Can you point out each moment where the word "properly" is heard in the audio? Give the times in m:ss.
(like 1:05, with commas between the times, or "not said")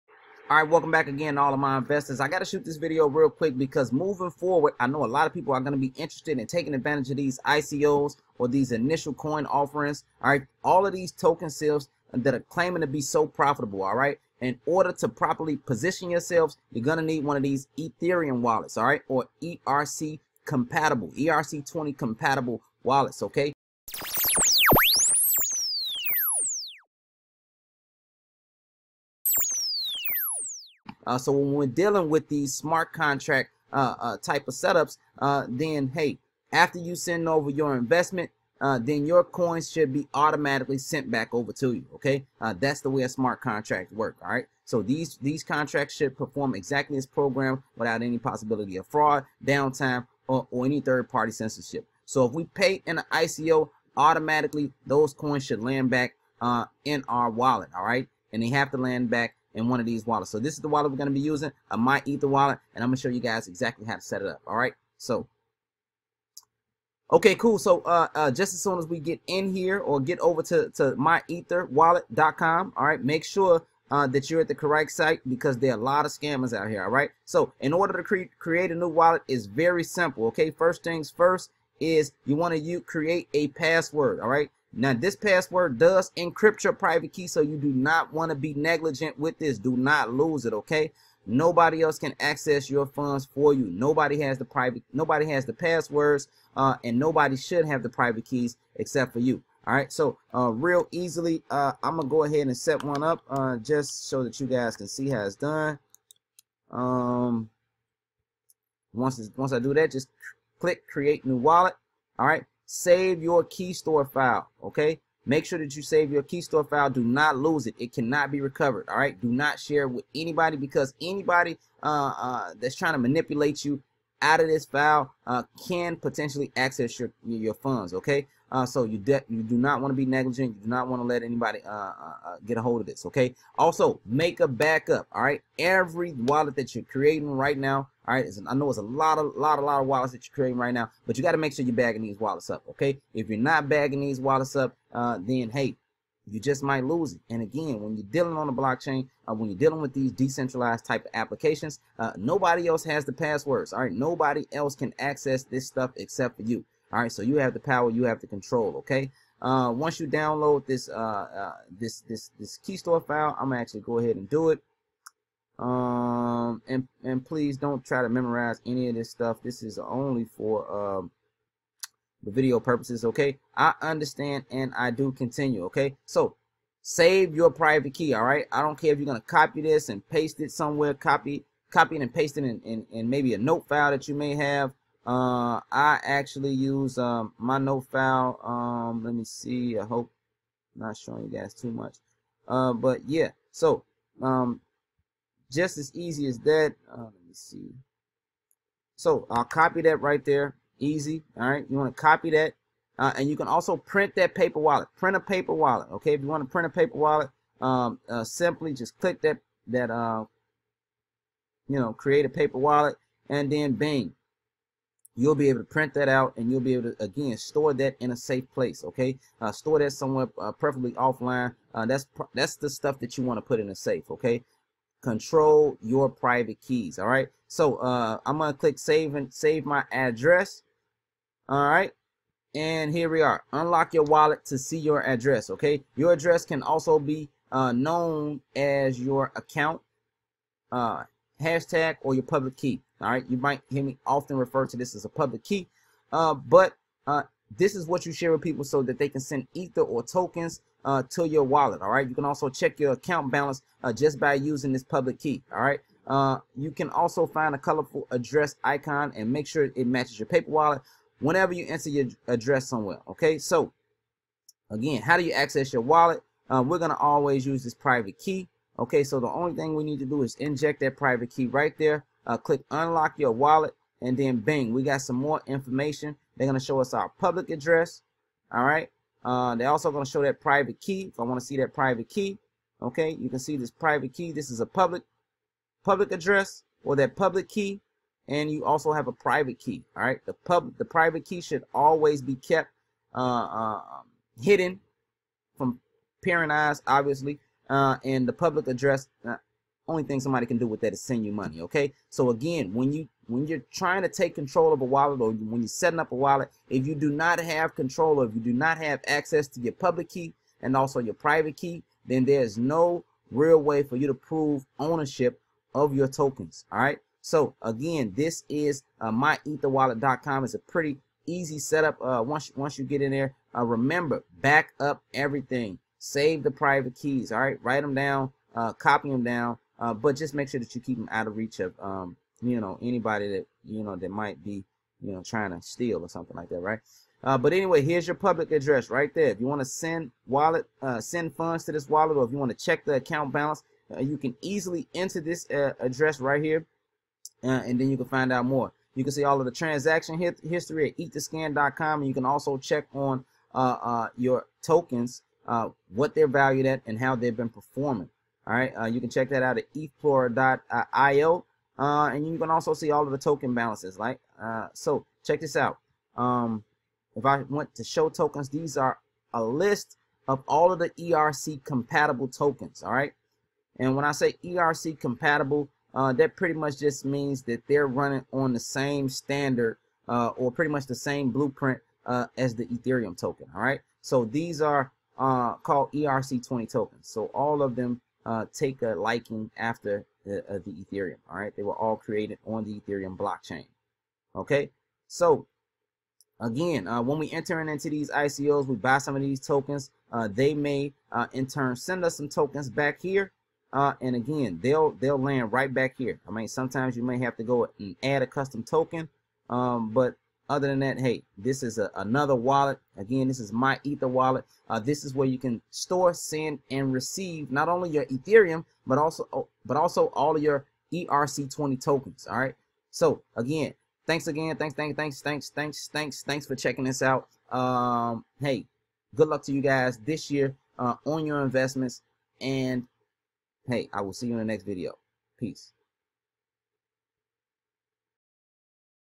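0:15.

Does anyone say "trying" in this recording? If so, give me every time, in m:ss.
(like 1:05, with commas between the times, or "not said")
2:02, 5:03, 5:35.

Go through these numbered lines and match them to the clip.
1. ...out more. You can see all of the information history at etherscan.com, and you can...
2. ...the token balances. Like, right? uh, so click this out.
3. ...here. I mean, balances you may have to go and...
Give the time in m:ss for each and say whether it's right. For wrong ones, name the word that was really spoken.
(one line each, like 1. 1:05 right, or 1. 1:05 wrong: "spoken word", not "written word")
1. 5:48 wrong: "transaction", not "information"
2. 6:03 wrong: "check", not "click"
3. 6:45 wrong: "sometimes", not "balances".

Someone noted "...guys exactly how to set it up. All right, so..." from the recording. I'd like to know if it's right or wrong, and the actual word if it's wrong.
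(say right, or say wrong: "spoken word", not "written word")
right.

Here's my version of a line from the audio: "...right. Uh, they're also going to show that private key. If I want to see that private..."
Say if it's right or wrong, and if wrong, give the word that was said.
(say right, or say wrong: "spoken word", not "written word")
right.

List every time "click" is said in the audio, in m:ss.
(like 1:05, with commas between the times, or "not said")
1:50, 3:28, 3:48, 4:32.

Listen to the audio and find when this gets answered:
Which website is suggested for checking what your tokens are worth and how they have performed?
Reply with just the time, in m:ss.
5:59.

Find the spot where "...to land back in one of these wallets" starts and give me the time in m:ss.
0:58.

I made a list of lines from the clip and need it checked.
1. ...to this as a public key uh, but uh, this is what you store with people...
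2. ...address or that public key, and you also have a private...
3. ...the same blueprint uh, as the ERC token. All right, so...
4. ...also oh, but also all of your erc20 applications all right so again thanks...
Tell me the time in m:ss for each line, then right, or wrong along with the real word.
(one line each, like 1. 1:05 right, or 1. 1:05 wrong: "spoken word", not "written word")
1. 4:04 wrong: "share", not "store"
2. 4:46 right
3. 6:20 wrong: "Ethereum", not "ERC"
4. 6:58 wrong: "tokens", not "applications".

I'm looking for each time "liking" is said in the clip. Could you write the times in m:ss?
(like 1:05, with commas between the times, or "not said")
6:28.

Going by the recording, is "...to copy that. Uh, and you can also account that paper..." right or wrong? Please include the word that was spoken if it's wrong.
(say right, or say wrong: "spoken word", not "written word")
wrong: "print", not "account".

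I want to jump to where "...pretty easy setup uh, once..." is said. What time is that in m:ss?
5:20.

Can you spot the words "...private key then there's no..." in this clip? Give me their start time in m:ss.
5:11.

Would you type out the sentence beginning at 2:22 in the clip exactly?
Okay, if you're not bagging these wallets up, uh, then hey, you just might lose it.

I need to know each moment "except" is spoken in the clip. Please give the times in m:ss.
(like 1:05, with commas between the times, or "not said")
1:38, 2:35.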